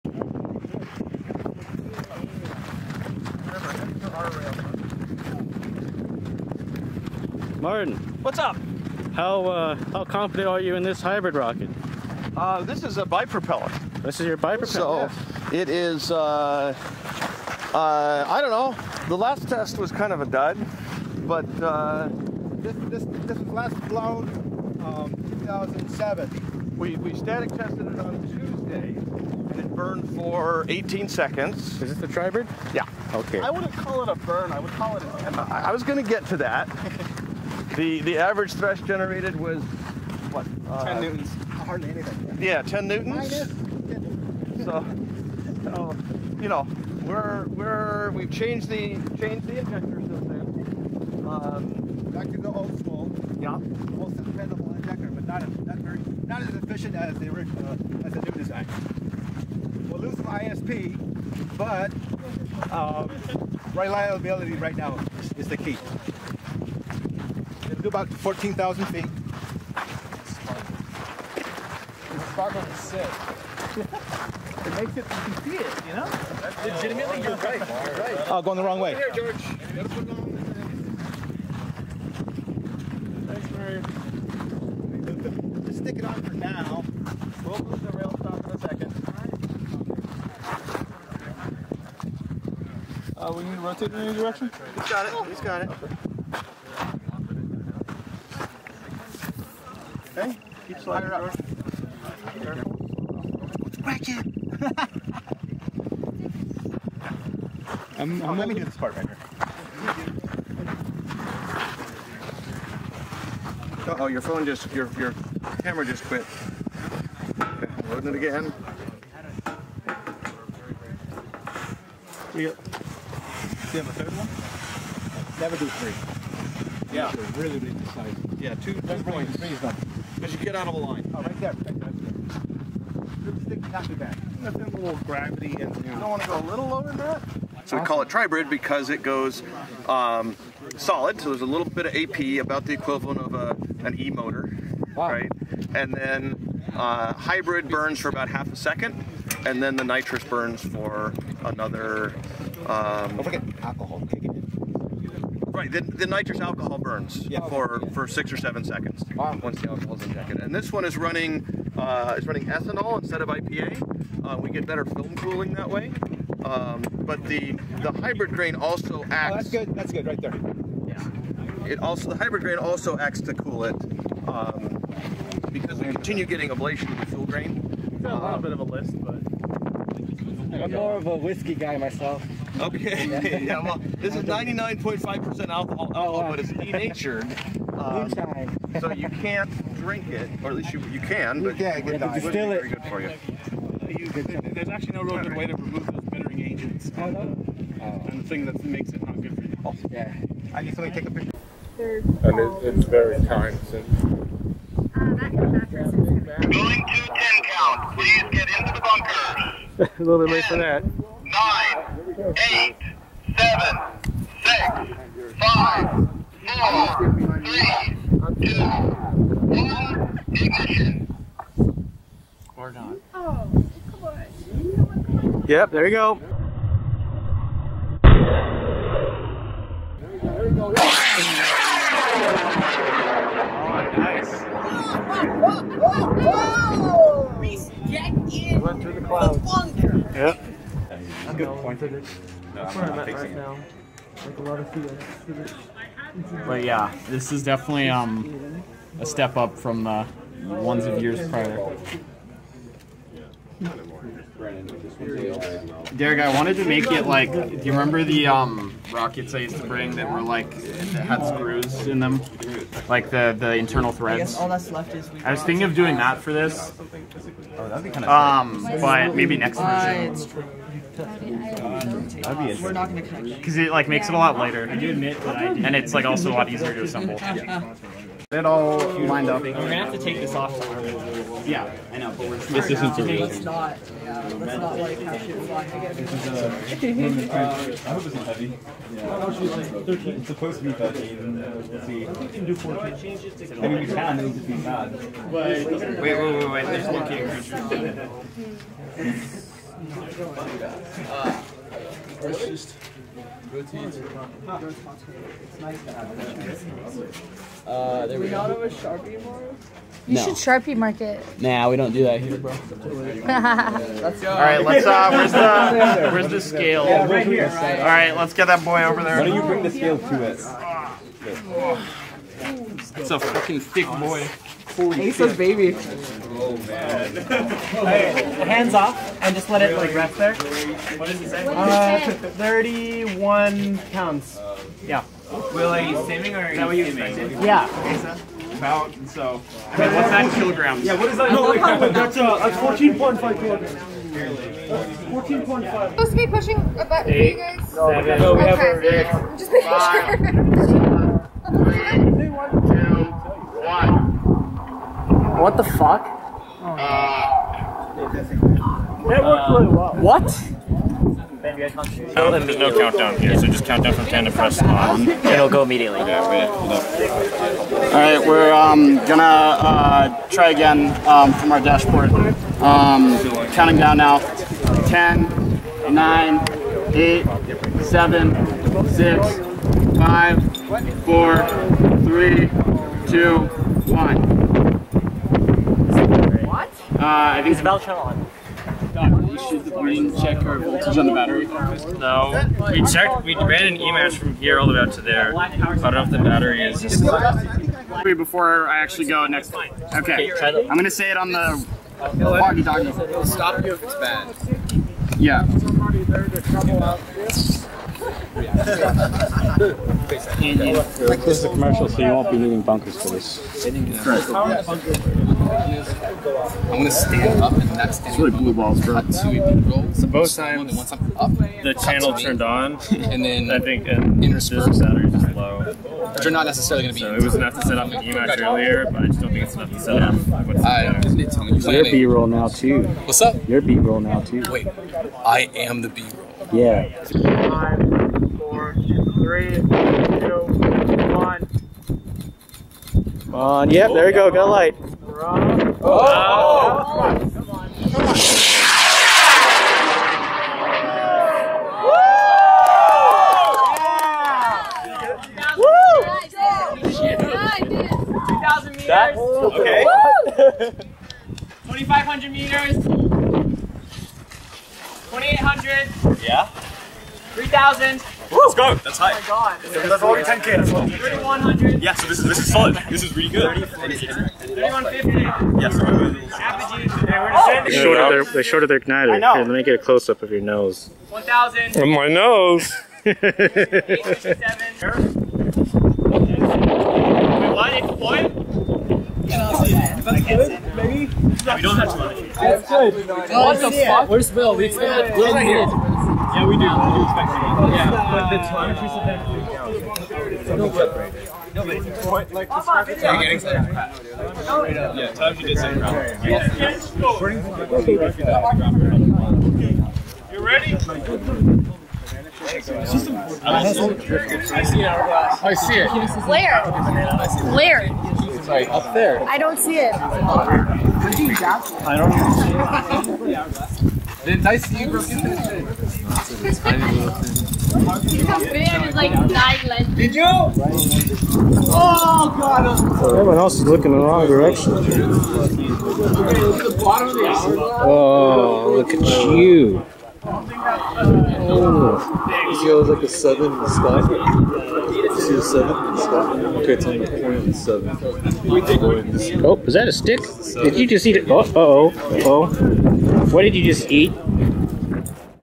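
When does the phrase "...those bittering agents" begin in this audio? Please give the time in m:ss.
3:15.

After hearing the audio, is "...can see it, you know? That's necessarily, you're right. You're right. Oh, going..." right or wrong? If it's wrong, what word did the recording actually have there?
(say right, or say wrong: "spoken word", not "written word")
wrong: "legitimately", not "necessarily".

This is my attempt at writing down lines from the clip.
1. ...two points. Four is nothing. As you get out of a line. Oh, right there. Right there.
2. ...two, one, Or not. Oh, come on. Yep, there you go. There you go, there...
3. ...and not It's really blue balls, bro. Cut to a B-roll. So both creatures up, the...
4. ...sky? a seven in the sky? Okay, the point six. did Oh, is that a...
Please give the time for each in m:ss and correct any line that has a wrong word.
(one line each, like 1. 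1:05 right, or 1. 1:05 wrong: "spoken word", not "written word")
1. 2:08 wrong: "Three", not "Four"
2. 3:38 right
3. 6:57 wrong: "times", not "creatures"
4. 9:03 wrong: "seven", not "six".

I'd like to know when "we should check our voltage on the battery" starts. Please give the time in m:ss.
6:29.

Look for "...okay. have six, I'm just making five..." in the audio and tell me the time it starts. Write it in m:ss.
5:48.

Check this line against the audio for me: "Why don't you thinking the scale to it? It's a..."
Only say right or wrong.
wrong.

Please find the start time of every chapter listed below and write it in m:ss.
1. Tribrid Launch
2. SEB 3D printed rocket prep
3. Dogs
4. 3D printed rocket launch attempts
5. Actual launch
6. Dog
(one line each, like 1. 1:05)
1. 3:22
2. 4:01
3. 5:34
4. 5:46
5. 7:17
6. 8:41.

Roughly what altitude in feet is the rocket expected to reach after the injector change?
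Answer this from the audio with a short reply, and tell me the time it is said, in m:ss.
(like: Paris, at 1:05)
14,000 feet, at 1:08.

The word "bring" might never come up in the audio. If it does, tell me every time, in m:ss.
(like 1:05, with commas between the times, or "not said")
4:19, 5:19.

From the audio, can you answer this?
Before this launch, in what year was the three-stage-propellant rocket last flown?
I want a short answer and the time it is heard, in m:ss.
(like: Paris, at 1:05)
2007, at 0:25.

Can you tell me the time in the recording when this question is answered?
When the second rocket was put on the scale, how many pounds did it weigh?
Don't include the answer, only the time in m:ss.
5:32.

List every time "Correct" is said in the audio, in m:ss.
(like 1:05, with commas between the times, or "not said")
6:54.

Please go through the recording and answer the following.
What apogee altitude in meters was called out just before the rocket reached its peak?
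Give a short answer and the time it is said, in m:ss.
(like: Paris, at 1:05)
3150, at 7:53.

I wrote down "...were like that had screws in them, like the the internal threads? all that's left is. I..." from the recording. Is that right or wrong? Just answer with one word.
right.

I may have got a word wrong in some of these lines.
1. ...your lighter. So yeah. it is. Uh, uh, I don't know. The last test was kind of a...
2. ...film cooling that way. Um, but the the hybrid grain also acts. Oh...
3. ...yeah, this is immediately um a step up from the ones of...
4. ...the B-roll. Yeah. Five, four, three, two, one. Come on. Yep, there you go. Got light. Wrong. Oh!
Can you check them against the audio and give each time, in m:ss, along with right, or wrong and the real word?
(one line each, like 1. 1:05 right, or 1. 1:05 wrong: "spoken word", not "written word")
1. 0:14 wrong: "bipropeller", not "lighter"
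2. 2:44 right
3. 4:06 wrong: "definitely", not "immediately"
4. 7:15 right.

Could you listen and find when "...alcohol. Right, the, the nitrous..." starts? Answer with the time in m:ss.
2:33.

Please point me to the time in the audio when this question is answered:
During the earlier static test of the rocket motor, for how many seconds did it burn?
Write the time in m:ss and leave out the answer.
0:30.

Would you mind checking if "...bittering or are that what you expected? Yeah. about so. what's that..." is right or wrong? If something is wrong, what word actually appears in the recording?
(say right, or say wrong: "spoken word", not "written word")
wrong: "saving", not "bittering".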